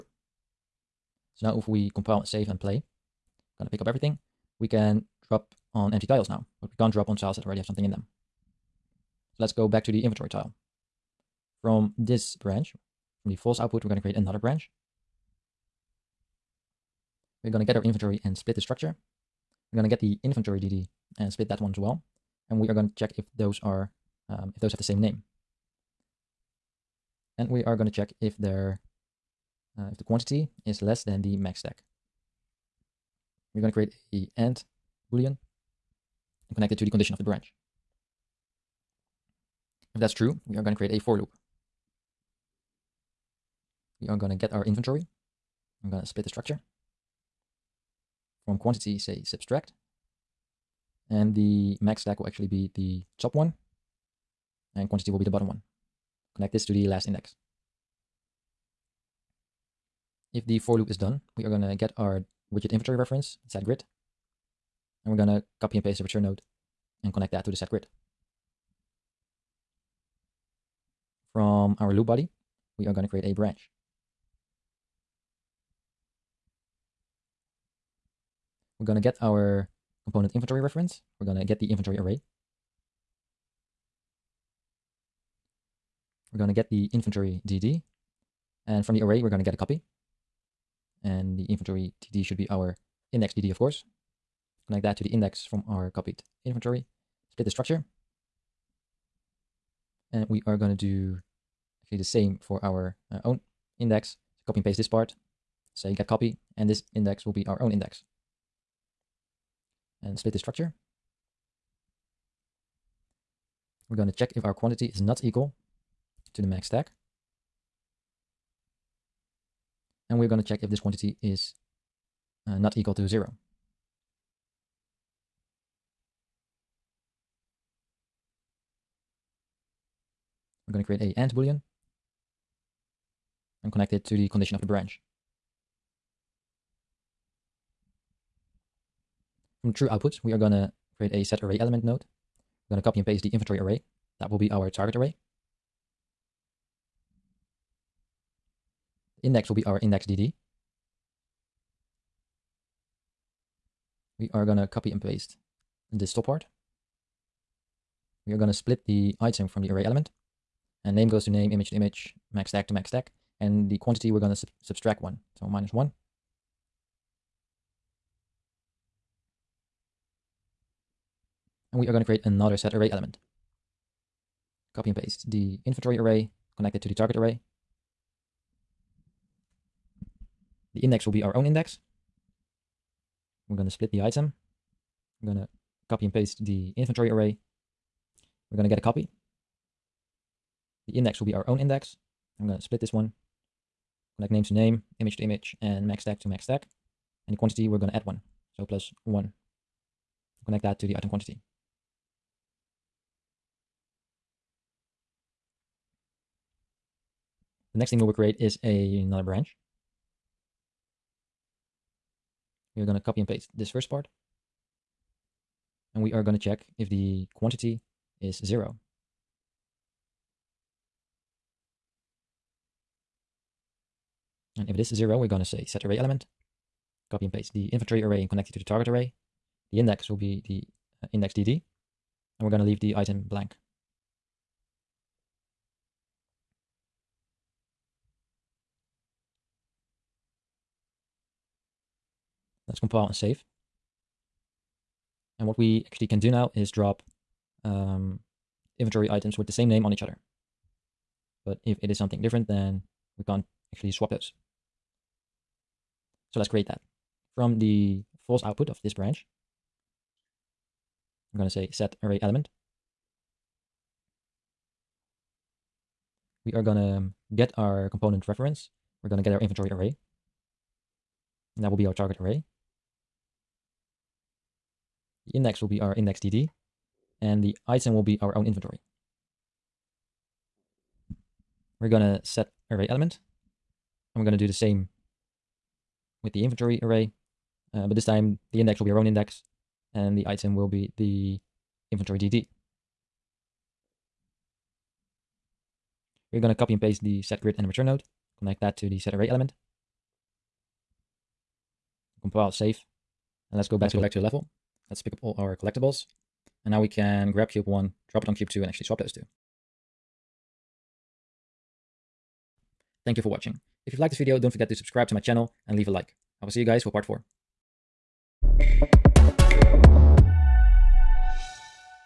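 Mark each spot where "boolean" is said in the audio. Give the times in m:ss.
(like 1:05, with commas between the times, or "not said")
0:35, 2:11.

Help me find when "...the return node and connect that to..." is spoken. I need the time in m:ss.
1:05.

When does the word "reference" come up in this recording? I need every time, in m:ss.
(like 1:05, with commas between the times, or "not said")
1:02, 1:20, 4:28.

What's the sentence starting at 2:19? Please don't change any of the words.
From true output, we are going to create a set array element node.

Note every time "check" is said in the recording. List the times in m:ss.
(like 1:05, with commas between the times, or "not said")
0:22, 0:27, 1:54, 2:00, 3:36.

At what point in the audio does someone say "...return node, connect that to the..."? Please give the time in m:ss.
4:57.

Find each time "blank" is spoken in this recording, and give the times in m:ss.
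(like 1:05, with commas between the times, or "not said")
3:53.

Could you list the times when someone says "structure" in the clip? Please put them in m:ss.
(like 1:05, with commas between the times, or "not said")
0:18, 0:46, 1:37, 1:50.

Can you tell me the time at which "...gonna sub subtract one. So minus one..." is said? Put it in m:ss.
2:44.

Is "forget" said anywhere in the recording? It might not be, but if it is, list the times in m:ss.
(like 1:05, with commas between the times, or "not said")
5:14.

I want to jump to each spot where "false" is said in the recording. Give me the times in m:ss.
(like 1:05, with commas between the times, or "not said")
0:13, 4:18.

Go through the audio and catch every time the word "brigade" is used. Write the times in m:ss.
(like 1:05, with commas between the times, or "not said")
not said.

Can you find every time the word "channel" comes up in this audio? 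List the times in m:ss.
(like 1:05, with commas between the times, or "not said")
5:15.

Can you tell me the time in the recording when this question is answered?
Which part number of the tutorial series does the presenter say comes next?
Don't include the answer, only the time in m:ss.
5:16.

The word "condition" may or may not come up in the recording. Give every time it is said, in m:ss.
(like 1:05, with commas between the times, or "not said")
0:36, 2:14.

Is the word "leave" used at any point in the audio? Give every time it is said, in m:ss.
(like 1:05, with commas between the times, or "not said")
3:52, 5:15.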